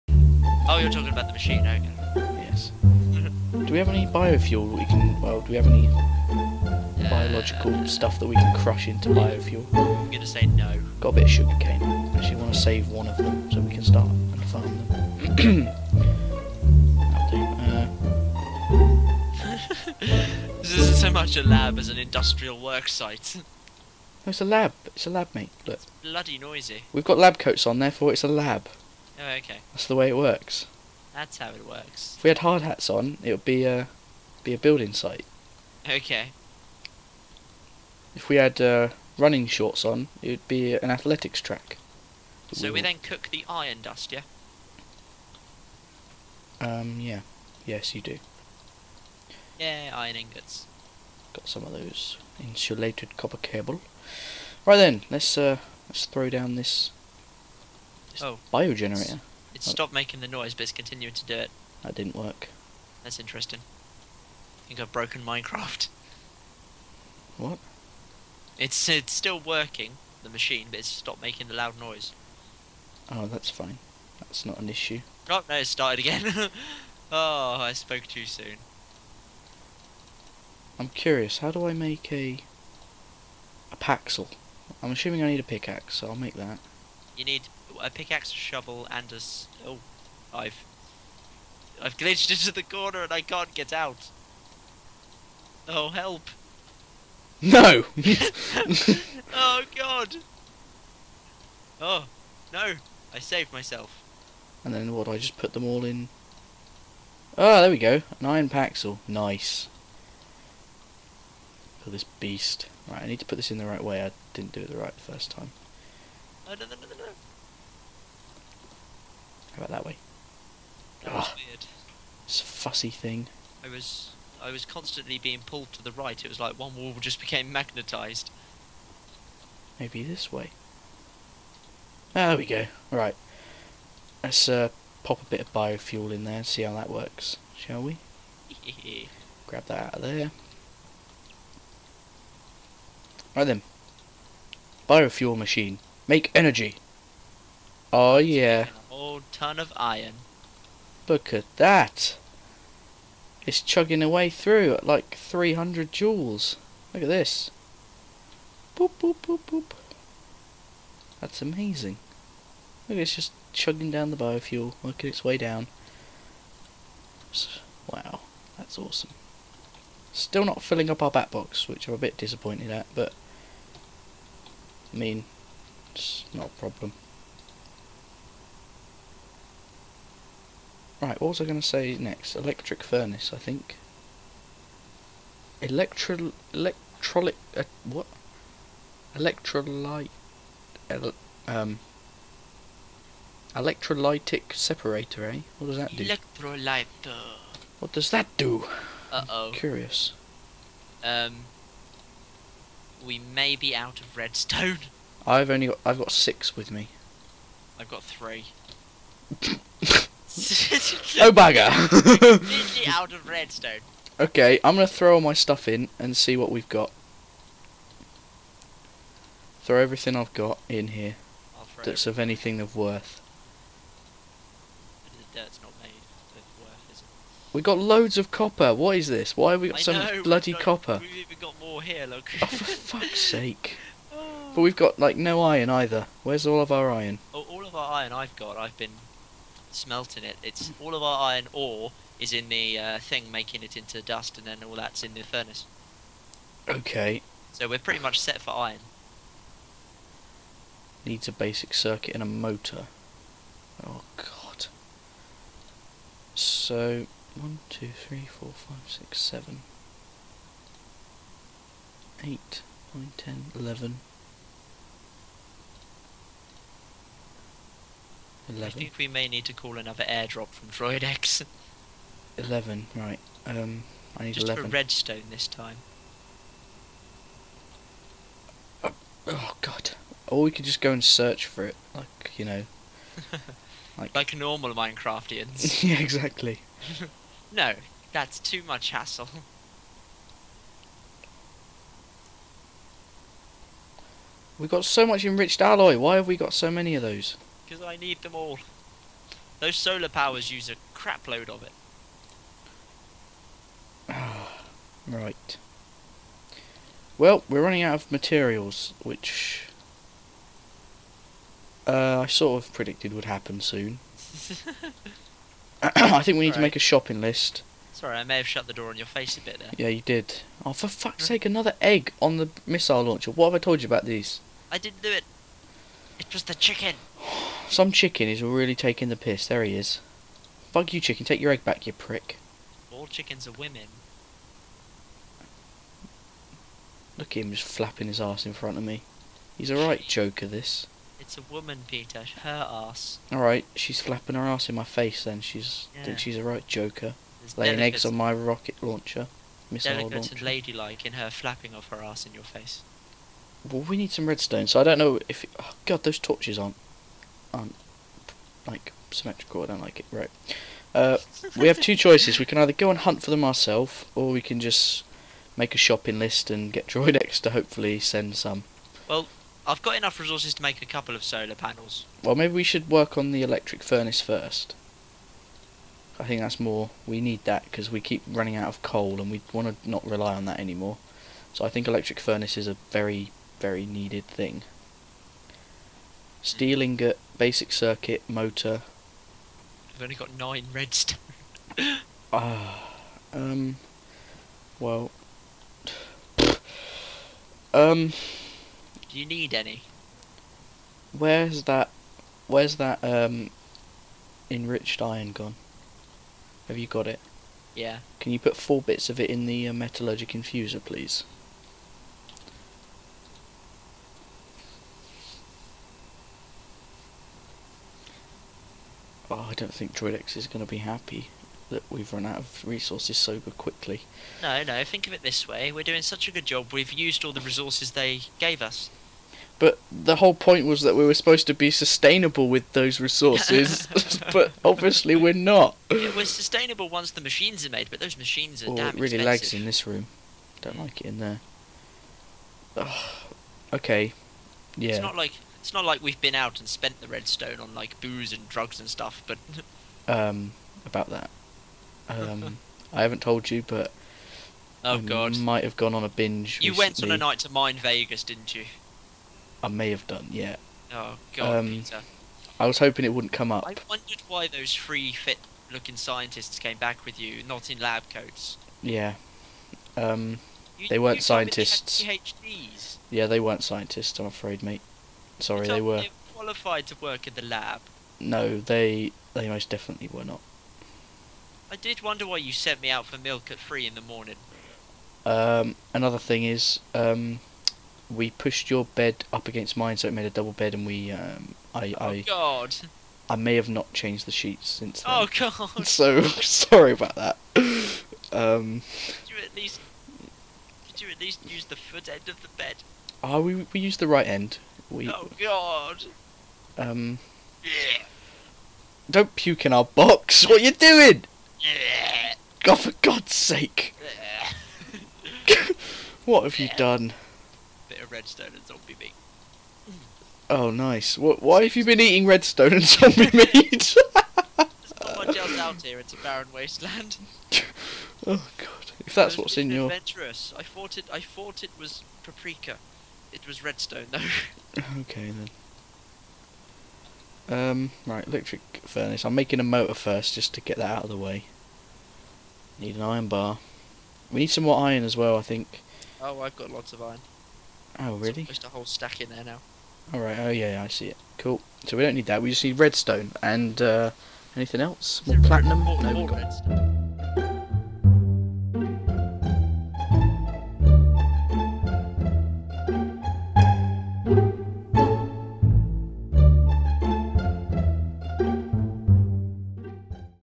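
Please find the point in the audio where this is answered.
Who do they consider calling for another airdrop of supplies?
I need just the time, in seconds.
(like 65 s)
270 s.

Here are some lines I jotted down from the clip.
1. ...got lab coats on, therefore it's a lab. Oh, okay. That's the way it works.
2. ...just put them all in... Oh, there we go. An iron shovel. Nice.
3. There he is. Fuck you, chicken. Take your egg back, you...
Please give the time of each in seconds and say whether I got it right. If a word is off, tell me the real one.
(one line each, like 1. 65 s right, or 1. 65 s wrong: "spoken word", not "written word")
1. 27 s right
2. 105 s wrong: "paxel", not "shovel"
3. 329 s right.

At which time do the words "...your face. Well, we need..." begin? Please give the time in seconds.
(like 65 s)
352 s.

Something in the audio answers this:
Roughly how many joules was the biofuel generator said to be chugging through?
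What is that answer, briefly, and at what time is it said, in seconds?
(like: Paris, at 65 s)
300, at 155 s.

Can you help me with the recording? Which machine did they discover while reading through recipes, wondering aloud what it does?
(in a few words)
Electrolytic separator.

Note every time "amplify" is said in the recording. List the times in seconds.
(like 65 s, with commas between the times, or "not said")
not said.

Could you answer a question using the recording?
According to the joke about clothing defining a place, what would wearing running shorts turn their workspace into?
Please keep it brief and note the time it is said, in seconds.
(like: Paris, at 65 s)
An athletics track, at 40 s.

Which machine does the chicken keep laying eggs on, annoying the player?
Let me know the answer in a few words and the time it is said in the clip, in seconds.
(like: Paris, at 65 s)
Missile launcher, at 322 s.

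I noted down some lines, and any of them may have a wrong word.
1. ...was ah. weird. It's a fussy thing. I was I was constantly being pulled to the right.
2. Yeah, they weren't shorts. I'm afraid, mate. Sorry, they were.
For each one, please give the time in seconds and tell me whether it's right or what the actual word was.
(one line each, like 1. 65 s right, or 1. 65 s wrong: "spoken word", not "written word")
1. 121 s right
2. 473 s wrong: "scientists", not "shorts".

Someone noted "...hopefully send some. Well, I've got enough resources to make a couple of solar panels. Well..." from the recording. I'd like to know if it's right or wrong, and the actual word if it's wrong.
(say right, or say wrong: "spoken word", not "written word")
right.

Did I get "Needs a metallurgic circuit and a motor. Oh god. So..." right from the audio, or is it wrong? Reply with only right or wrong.
wrong.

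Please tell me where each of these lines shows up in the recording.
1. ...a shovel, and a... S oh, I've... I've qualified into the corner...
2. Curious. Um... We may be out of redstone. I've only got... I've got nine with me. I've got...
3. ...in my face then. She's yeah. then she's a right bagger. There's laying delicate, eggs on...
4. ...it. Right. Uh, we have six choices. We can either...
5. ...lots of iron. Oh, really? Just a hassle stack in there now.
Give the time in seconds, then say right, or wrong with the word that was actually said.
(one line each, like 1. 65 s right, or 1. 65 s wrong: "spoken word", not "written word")
1. 88 s wrong: "glitched", not "qualified"
2. 199 s wrong: "six", not "nine"
3. 344 s wrong: "joker", not "bagger"
4. 359 s wrong: "two", not "six"
5. 546 s wrong: "whole", not "hassle".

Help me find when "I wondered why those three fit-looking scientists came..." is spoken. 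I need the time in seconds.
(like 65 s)
463 s.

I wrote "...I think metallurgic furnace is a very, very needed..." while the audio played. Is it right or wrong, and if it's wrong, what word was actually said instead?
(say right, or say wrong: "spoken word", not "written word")
wrong: "electric", not "metallurgic".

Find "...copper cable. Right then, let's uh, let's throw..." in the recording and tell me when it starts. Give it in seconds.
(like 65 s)
53 s.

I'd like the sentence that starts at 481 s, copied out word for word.
I did wonder why you sent me out for milk at three in the morning.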